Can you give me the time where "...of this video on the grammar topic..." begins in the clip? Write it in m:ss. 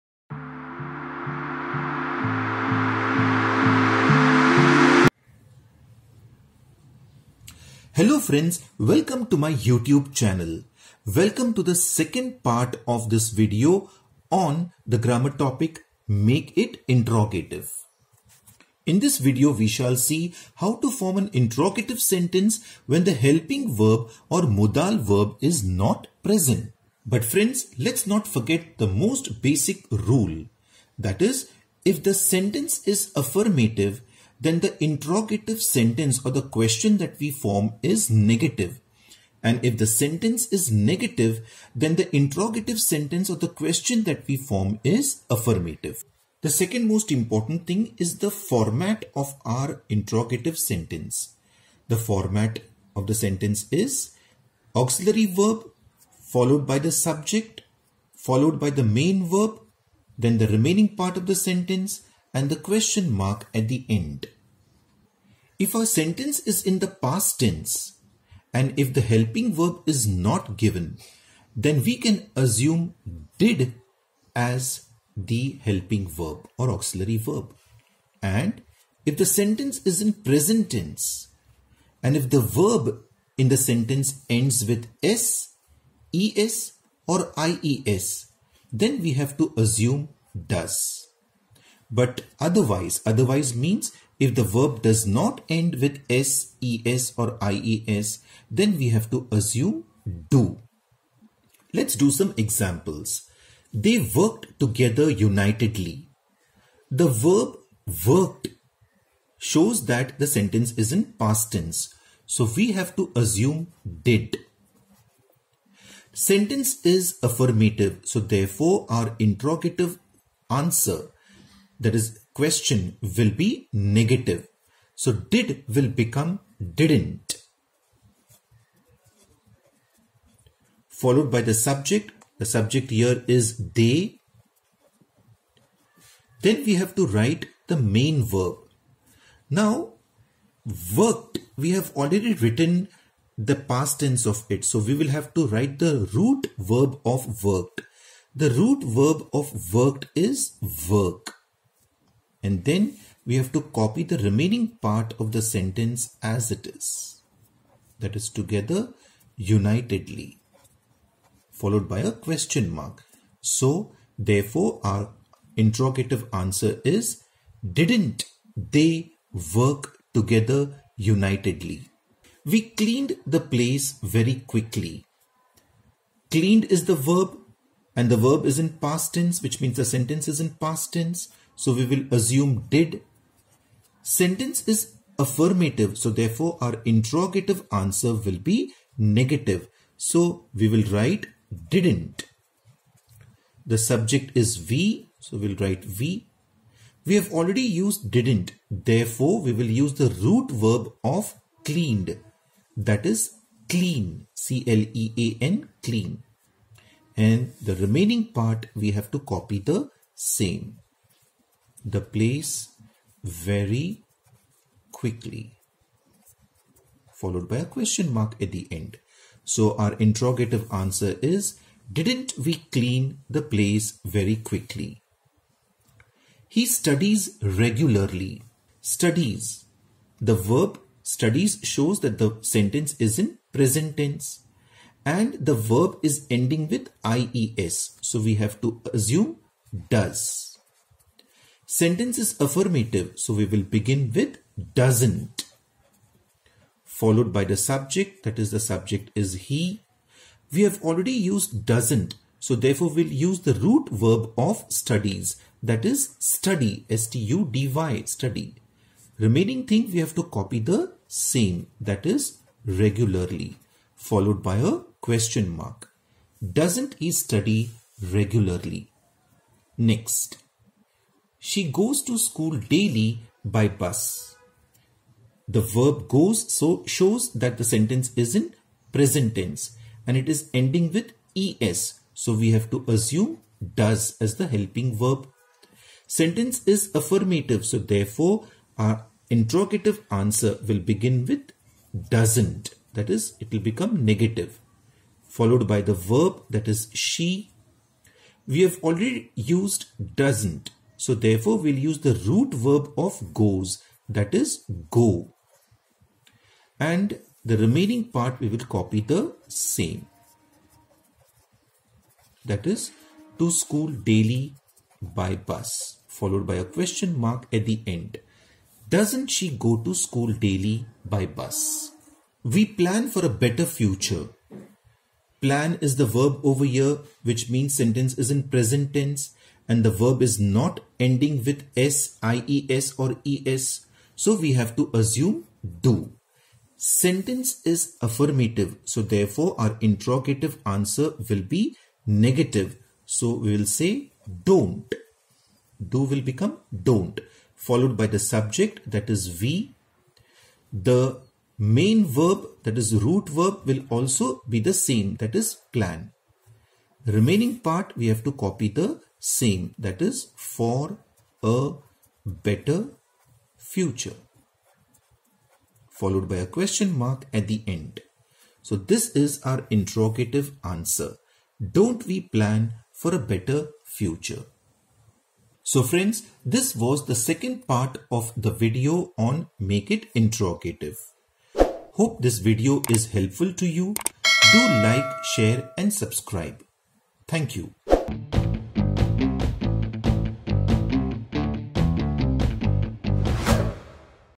0:12.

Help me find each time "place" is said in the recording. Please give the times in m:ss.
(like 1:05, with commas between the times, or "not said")
2:53, 3:32, 3:43.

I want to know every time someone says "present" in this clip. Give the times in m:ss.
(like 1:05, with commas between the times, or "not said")
0:26, 1:20, 3:53, 4:38, 5:28.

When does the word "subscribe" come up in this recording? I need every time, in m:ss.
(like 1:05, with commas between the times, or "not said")
6:25.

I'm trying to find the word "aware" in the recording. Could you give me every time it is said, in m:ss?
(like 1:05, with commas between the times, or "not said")
not said.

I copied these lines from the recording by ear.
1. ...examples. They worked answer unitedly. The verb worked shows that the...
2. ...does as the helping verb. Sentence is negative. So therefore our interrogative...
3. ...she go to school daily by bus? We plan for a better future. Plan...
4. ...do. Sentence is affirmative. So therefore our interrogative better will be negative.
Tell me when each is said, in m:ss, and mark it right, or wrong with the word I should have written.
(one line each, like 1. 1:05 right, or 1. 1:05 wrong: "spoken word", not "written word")
1. 1:42 wrong: "together", not "answer"
2. 4:43 wrong: "affirmative", not "negative"
3. 5:19 right
4. 5:35 wrong: "answer", not "better".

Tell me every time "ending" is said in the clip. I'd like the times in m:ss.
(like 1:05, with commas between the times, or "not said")
3:56, 4:40, 5:31.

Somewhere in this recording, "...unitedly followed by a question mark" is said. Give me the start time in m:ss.
2:39.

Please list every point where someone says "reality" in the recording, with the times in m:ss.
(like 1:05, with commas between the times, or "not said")
not said.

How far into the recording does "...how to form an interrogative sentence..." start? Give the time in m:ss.
0:20.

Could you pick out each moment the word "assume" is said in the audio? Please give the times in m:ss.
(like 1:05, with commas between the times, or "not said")
1:12, 1:29, 1:39, 1:53, 3:02, 3:58, 4:42, 5:34.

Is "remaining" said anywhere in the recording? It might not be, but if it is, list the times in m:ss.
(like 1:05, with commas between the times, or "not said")
1:00, 2:34, 3:27, 4:19, 5:07, 5:57.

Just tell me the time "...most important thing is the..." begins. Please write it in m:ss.
0:46.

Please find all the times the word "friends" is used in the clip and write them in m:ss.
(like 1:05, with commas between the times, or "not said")
0:08, 0:27, 6:15.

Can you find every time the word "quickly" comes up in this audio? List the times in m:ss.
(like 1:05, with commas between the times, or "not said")
2:54, 3:34, 3:44.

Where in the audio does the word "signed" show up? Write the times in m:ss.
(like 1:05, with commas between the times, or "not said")
not said.